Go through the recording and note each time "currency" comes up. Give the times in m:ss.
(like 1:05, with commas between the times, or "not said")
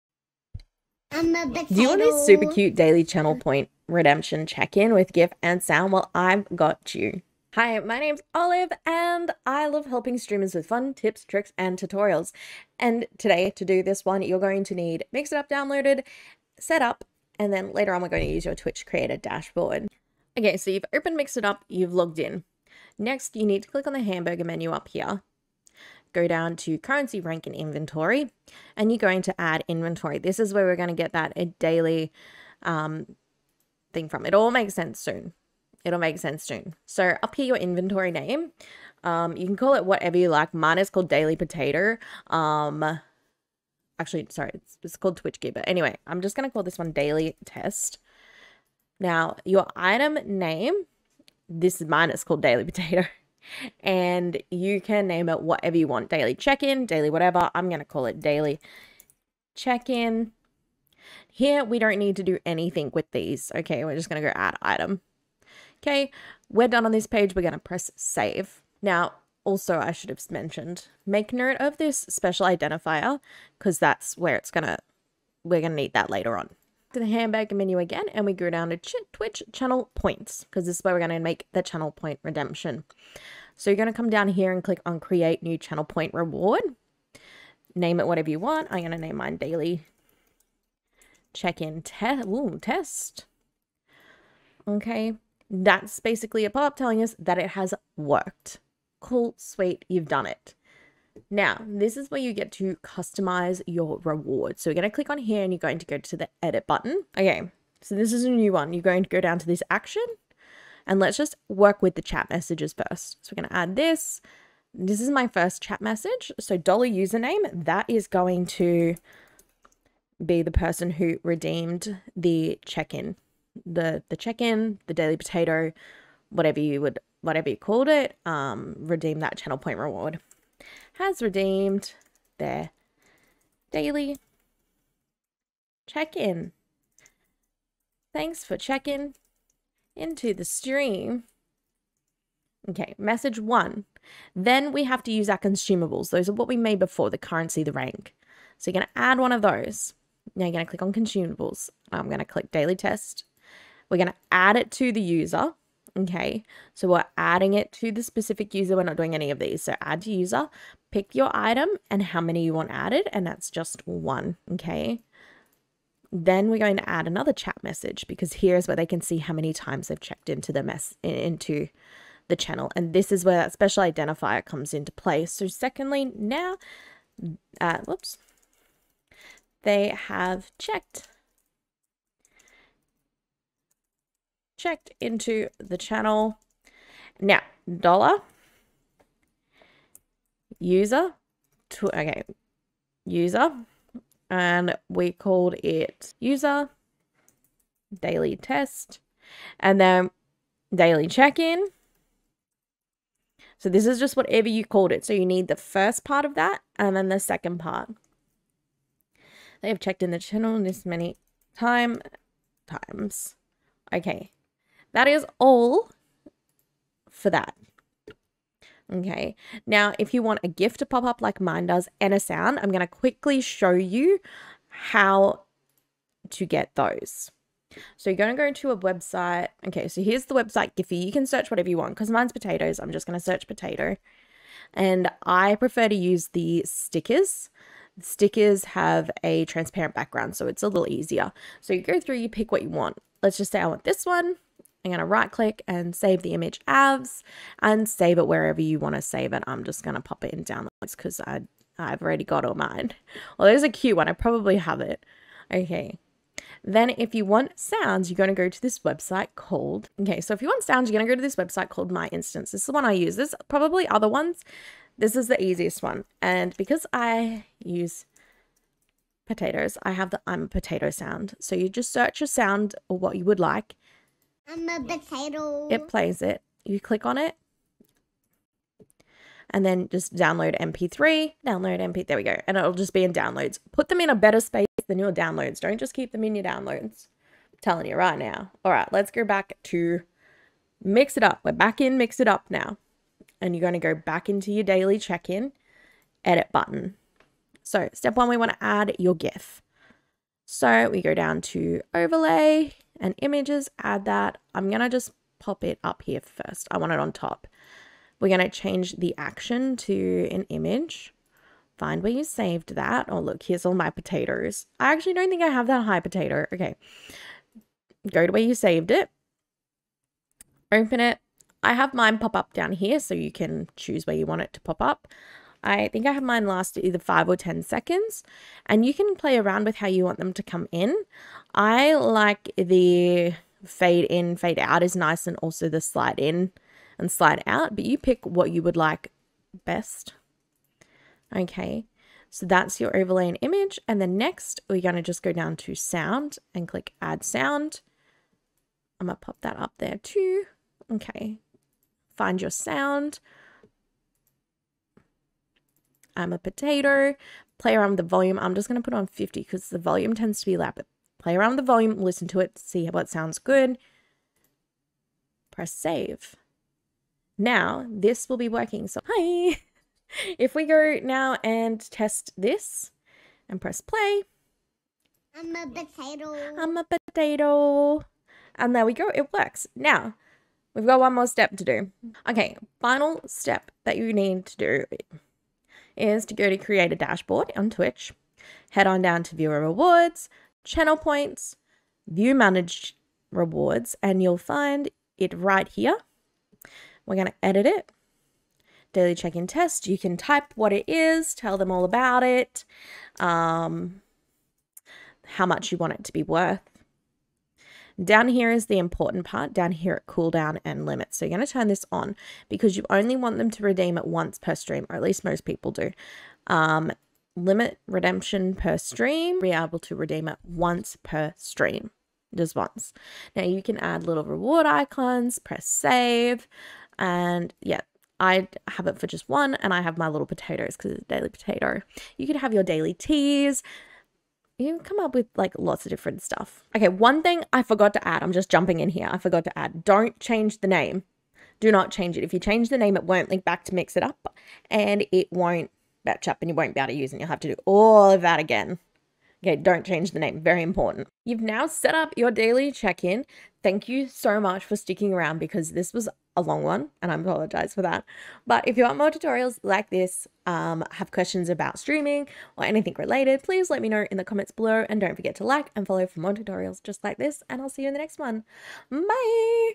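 0:26, 2:27.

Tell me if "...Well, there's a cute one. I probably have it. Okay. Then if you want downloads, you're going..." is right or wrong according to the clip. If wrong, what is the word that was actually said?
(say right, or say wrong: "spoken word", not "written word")
wrong: "sounds", not "downloads".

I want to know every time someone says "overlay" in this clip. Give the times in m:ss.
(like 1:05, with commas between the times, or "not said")
5:01, 5:42.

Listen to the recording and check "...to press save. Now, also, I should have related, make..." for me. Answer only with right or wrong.
wrong.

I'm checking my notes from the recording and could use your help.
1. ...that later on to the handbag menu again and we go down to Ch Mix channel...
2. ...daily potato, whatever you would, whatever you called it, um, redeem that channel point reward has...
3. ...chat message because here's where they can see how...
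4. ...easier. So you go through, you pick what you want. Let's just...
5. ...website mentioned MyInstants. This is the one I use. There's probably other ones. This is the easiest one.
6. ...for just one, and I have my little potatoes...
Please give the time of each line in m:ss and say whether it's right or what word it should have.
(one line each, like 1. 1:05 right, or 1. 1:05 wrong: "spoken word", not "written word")
1. 1:15 wrong: "Twitch", not "Mix"
2. 2:04 right
3. 2:47 right
4. 4:00 right
5. 4:21 wrong: "called", not "mentioned"
6. 7:08 right.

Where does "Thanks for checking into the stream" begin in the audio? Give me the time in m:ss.
2:18.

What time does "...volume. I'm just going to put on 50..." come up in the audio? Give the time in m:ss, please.
5:58.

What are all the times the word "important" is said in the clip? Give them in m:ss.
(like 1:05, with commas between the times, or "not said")
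6:48, 7:30.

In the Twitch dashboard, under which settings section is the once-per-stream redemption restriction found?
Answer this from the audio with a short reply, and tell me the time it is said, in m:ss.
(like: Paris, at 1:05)
cooldown and limit, at 6:50.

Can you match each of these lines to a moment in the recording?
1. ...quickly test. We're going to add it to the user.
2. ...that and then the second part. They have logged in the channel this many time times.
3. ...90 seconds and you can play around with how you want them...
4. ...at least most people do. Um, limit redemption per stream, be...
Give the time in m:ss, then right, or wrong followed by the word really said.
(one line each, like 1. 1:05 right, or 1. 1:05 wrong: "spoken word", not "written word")
1. 2:32 wrong: "daily", not "quickly"
2. 3:26 wrong: "checked", not "logged"
3. 5:27 wrong: "10", not "90"
4. 6:54 right.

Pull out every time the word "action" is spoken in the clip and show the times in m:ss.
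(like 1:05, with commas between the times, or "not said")
1:49, 5:09.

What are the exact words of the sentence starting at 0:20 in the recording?
Okay, so you've opened Mix It Up, you've logged in.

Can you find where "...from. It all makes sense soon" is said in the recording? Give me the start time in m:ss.
0:34.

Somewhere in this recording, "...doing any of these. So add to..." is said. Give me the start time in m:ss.
2:38.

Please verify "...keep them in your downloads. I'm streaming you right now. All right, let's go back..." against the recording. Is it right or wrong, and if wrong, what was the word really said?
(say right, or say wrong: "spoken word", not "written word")
wrong: "telling", not "streaming".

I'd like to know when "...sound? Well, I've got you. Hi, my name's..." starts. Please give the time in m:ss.
0:05.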